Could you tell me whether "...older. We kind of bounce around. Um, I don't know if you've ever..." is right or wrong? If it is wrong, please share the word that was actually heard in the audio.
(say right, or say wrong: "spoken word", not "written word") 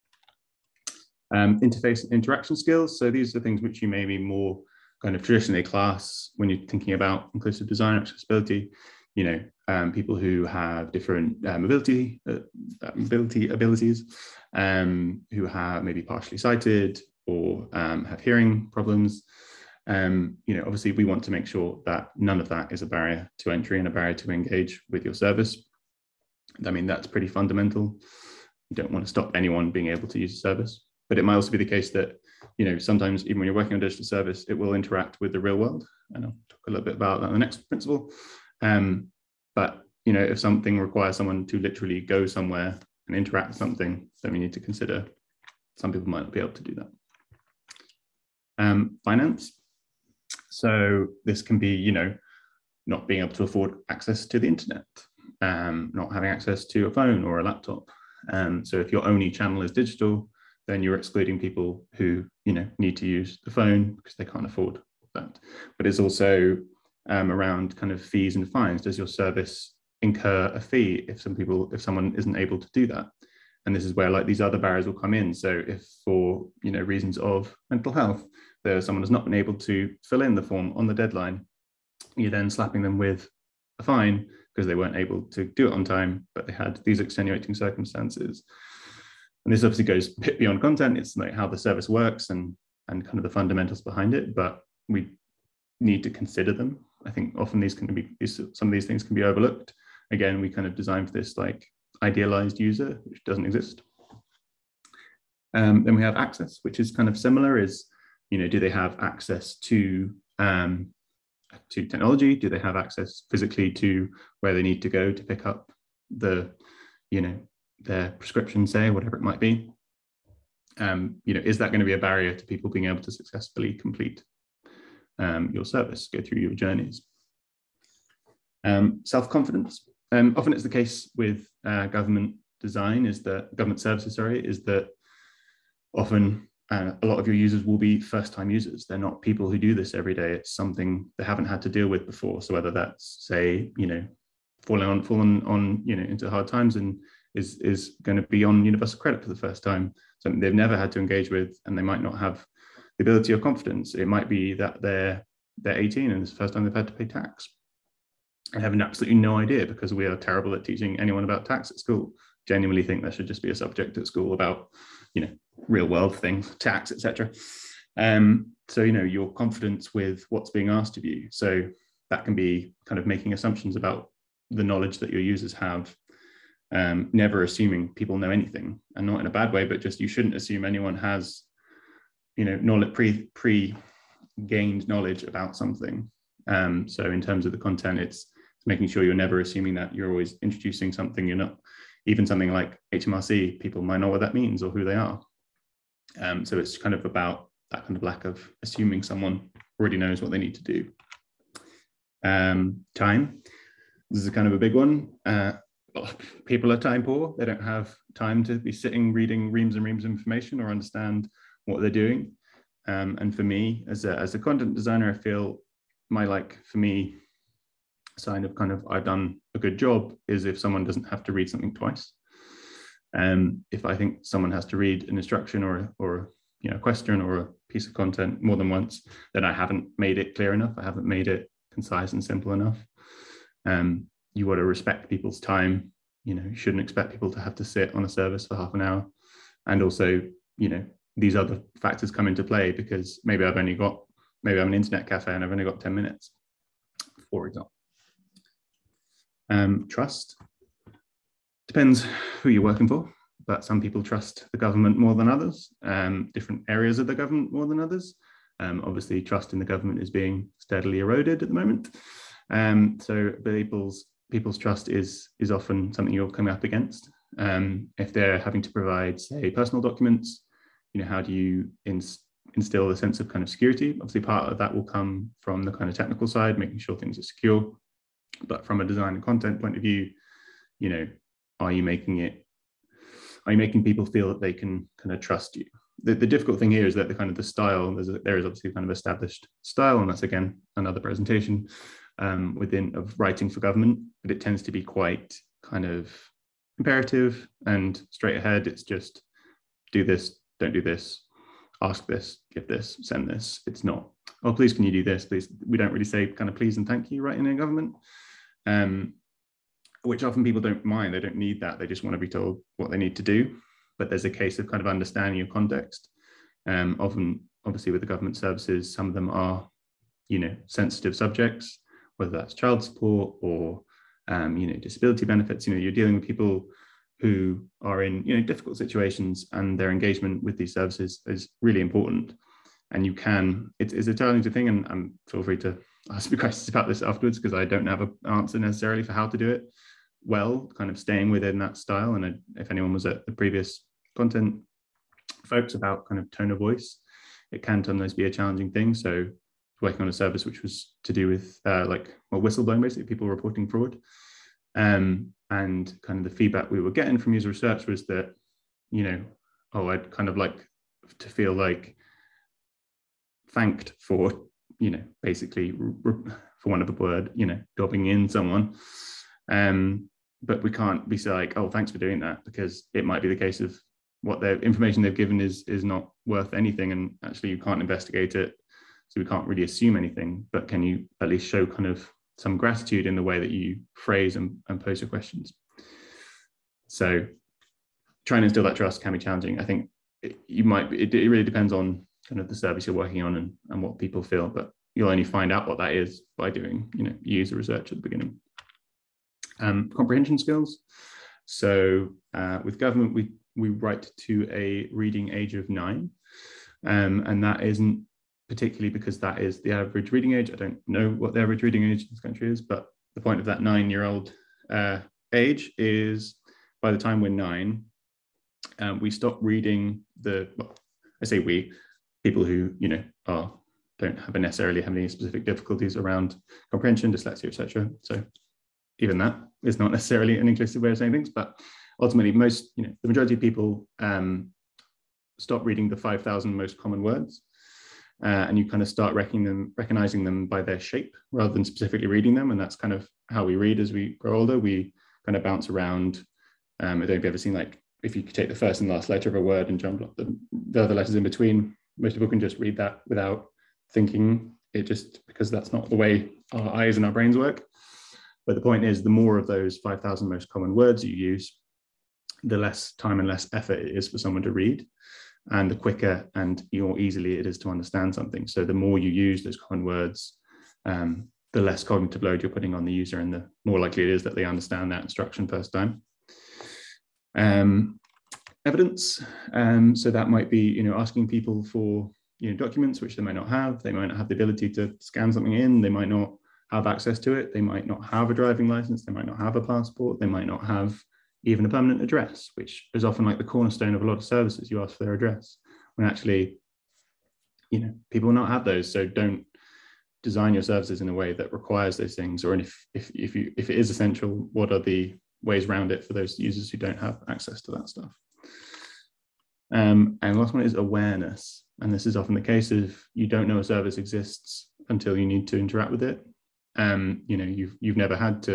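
right.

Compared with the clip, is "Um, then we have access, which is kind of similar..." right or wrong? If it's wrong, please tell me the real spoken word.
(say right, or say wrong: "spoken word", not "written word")
right.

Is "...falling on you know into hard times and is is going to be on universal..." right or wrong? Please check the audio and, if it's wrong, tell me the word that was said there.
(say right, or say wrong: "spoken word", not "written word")
right.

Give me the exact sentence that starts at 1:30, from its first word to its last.
It's like how the service works and and kind of the fundamentals behind it, but we need to consider them.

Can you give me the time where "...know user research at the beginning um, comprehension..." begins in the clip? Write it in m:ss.
6:37.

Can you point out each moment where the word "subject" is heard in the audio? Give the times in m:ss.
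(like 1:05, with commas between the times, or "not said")
2:43, 5:21.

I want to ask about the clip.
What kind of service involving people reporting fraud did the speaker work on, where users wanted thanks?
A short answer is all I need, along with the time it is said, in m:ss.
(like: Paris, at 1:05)
whistleblowing, at 5:52.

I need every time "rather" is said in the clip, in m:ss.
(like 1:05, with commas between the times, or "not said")
7:21.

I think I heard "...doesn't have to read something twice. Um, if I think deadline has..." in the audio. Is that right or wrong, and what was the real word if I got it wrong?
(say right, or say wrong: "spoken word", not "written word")
wrong: "someone", not "deadline".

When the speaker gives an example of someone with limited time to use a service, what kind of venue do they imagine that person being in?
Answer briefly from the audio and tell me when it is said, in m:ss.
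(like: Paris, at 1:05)
internet cafe, at 4:04.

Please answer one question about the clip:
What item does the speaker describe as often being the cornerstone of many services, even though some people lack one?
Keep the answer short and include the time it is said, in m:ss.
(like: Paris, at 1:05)
permanent address, at 8:11.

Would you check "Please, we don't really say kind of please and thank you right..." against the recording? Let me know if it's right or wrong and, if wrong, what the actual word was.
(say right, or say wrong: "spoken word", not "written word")
right.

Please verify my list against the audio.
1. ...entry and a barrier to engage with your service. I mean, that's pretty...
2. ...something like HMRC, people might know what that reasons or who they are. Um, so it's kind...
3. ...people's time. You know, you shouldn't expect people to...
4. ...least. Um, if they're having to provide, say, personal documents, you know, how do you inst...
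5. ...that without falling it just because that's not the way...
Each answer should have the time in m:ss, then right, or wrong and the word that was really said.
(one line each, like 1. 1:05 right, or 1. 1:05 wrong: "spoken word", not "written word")
1. 0:23 right
2. 3:12 wrong: "means", not "reasons"
3. 3:55 right
4. 4:26 wrong: "against", not "least"
5. 7:32 wrong: "thinking", not "falling".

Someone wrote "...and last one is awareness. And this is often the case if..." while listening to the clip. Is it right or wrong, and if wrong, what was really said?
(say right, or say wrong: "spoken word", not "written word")
right.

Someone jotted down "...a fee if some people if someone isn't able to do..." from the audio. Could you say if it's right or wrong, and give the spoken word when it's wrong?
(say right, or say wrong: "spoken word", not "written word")
right.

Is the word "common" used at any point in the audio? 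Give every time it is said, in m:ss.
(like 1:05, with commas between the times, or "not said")
7:16, 7:40, 7:49.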